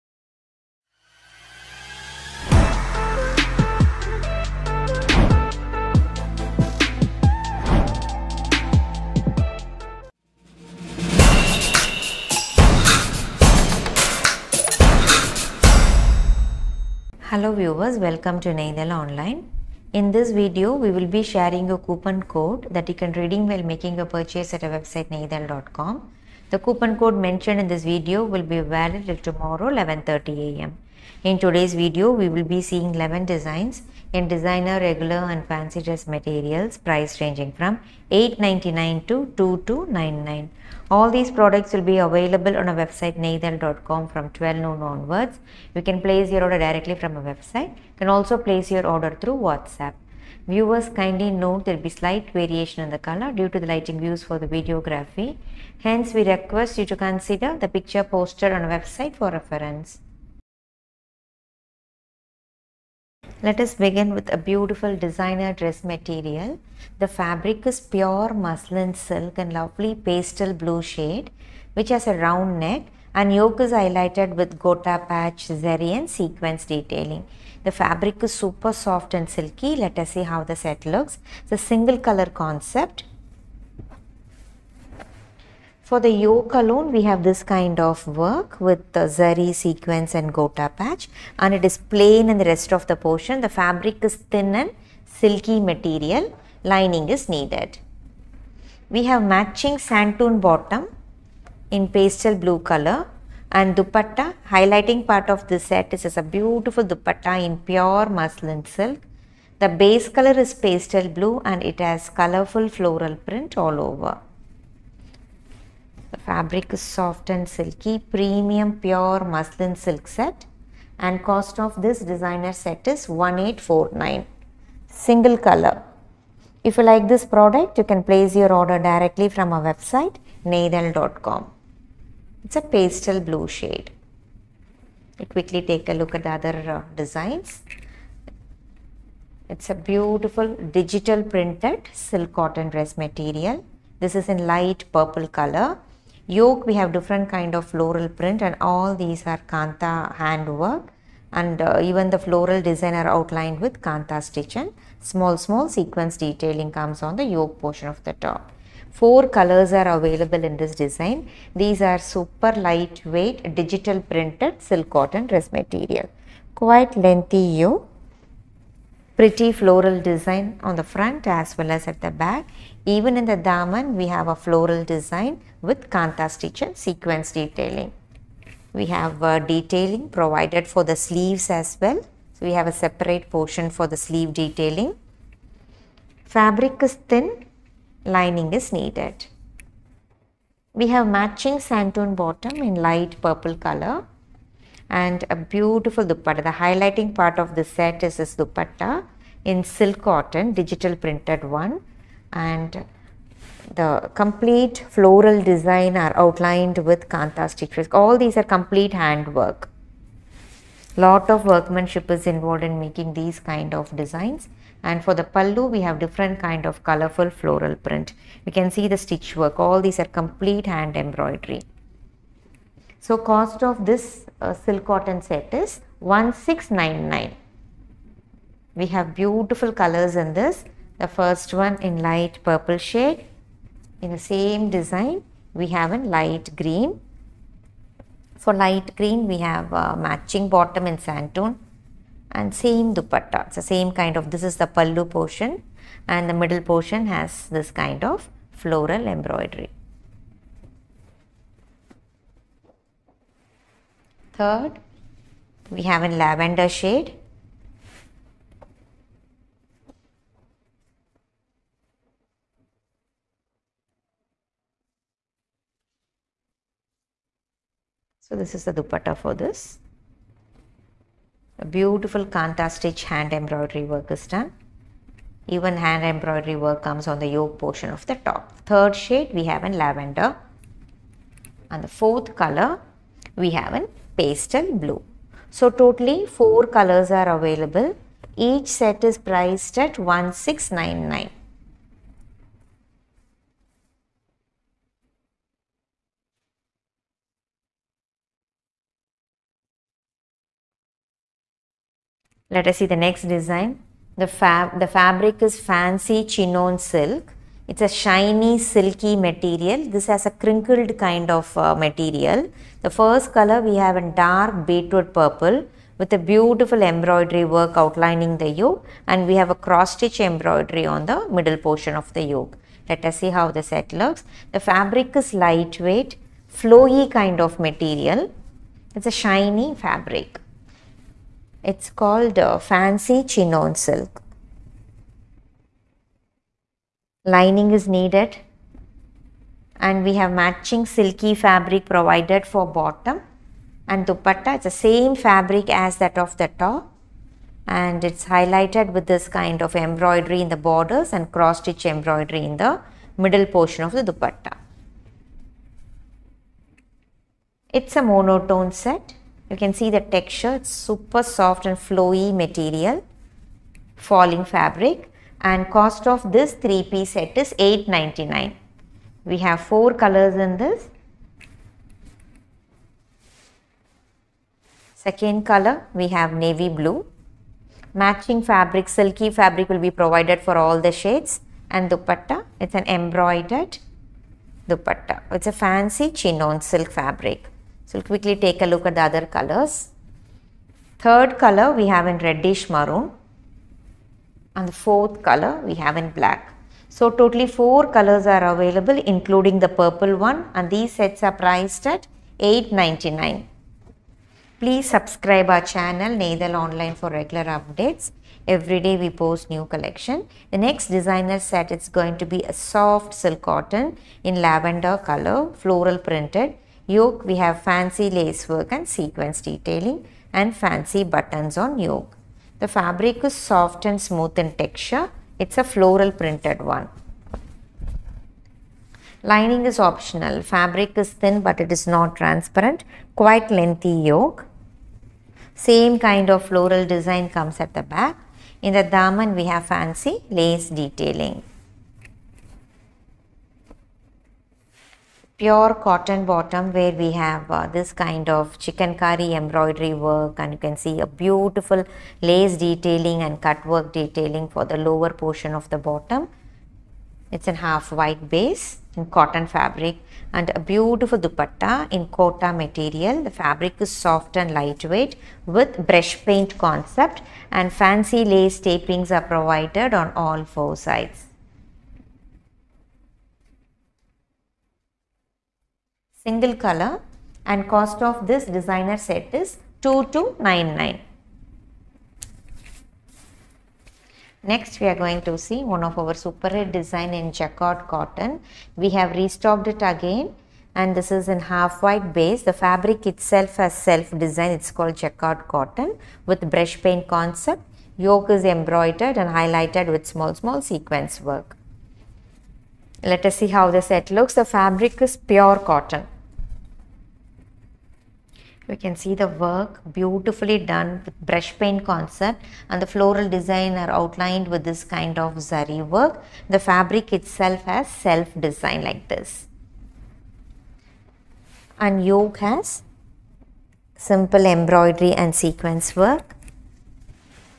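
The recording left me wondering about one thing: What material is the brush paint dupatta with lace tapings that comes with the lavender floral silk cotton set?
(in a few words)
Kota.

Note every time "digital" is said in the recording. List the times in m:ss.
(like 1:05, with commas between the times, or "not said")
2:20, 2:43, 3:20.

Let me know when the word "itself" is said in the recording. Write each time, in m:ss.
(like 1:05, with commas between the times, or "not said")
8:13, 8:37.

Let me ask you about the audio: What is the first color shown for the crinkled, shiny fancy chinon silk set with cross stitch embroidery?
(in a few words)
Dark beetroot purple.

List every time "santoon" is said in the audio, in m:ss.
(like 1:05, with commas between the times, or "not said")
1:39, 3:11, 4:01.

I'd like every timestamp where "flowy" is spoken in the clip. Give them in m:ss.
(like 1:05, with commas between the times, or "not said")
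5:26, 6:01.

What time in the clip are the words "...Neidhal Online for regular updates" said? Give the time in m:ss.
6:46.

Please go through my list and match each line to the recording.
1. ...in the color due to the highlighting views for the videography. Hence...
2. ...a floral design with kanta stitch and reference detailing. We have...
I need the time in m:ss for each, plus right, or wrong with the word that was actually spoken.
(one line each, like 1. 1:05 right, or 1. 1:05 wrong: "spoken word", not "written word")
1. 0:52 wrong: "lighting", not "highlighting"
2. 2:54 wrong: "sequence", not "reference".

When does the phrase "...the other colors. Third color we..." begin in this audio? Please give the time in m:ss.
6:28.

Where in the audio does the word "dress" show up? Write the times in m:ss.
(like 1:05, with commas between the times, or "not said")
0:35, 1:05, 2:22, 2:45.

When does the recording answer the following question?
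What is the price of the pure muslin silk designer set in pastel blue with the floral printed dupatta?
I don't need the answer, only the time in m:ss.
2:03.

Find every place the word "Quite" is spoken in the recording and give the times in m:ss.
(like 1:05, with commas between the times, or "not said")
2:46, 7:13.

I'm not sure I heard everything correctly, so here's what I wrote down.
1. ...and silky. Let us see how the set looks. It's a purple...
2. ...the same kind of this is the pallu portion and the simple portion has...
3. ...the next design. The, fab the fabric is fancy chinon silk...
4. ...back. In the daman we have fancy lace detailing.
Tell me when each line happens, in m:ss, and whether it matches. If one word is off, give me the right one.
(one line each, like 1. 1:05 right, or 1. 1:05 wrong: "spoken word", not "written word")
1. 1:19 wrong: "single", not "purple"
2. 4:03 wrong: "middle", not "simple"
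3. 5:02 right
4. 7:17 right.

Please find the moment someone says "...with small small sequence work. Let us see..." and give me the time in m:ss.
8:19.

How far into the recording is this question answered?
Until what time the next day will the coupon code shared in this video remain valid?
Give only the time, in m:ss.
0:29.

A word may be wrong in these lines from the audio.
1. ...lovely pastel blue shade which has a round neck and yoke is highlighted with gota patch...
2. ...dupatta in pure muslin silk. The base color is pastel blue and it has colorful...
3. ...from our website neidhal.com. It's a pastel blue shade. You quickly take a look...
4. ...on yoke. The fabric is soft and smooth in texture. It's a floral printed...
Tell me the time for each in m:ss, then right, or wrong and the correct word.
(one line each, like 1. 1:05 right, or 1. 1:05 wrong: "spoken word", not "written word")
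1. 1:09 right
2. 1:46 right
3. 2:09 right
4. 7:01 right.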